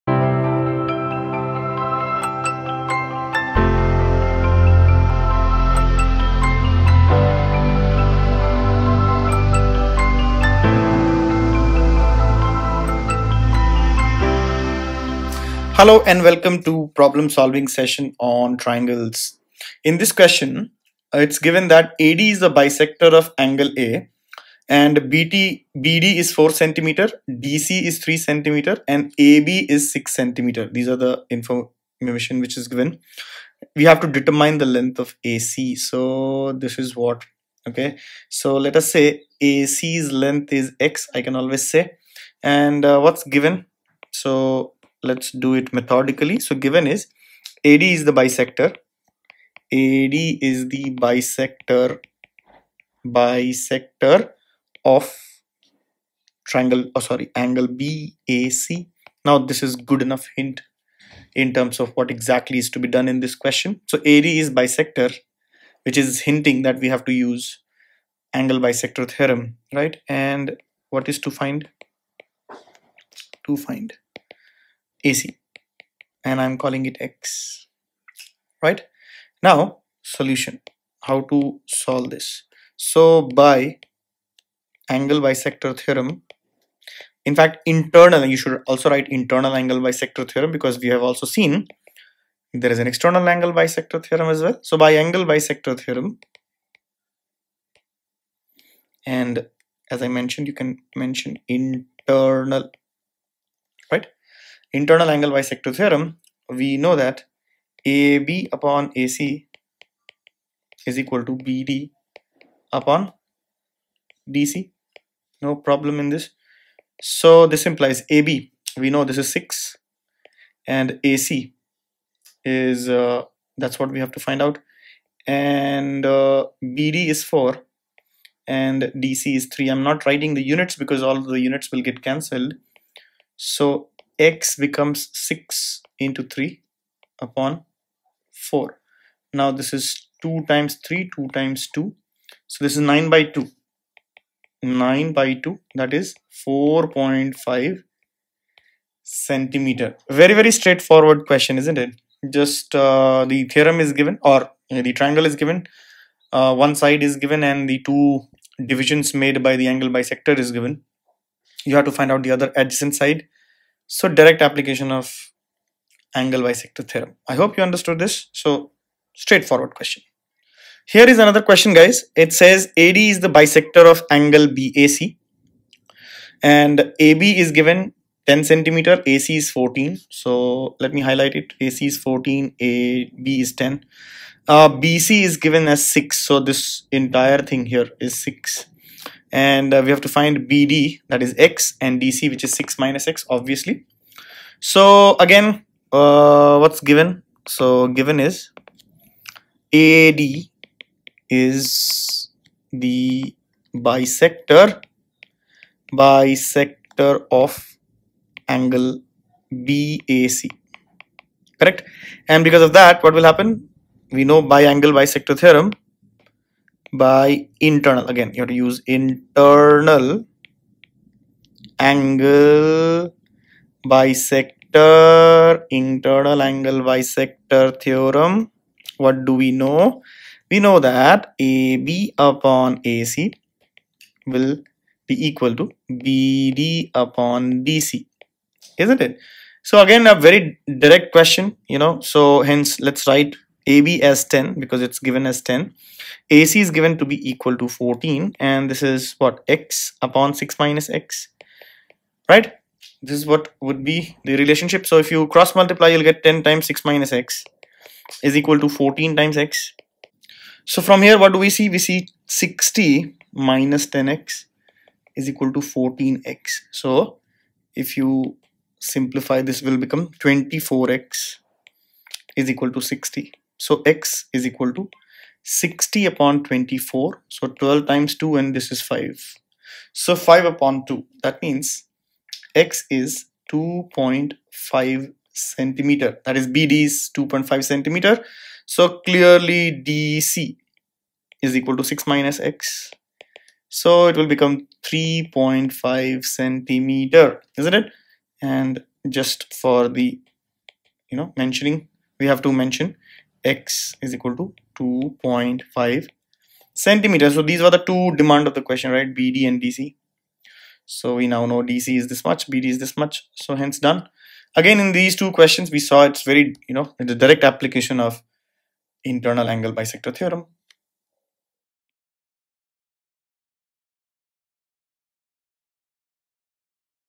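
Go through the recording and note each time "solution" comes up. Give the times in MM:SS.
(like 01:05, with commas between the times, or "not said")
01:20.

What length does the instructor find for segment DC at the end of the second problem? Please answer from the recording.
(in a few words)
3.5 cm.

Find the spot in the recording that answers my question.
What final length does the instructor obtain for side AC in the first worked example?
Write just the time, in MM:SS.
02:26.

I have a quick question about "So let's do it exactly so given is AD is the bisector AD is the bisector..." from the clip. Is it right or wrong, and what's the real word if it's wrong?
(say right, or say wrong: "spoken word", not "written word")
wrong: "methodically", not "exactly".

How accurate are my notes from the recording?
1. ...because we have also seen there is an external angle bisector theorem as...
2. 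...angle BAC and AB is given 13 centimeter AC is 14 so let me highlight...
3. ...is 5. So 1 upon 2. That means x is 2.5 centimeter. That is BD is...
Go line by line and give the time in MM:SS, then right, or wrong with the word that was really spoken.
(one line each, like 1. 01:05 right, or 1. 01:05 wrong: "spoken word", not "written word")
1. 01:30 right
2. 02:54 wrong: "10", not "13"
3. 04:38 wrong: "5", not "1".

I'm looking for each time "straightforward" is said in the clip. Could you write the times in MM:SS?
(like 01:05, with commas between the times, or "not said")
02:30, 02:49.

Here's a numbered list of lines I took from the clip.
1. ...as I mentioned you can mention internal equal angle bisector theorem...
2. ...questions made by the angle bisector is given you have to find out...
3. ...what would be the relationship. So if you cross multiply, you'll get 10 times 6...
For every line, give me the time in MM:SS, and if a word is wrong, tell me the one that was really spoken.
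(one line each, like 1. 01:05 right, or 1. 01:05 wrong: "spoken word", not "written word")
1. 01:39 wrong: "internal", not "equal"
2. 02:38 wrong: "divisions", not "questions"
3. 04:13 right.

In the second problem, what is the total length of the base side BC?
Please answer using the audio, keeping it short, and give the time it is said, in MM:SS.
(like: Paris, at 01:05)
6, at 03:04.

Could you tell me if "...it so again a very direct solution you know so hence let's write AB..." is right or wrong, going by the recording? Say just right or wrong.
wrong.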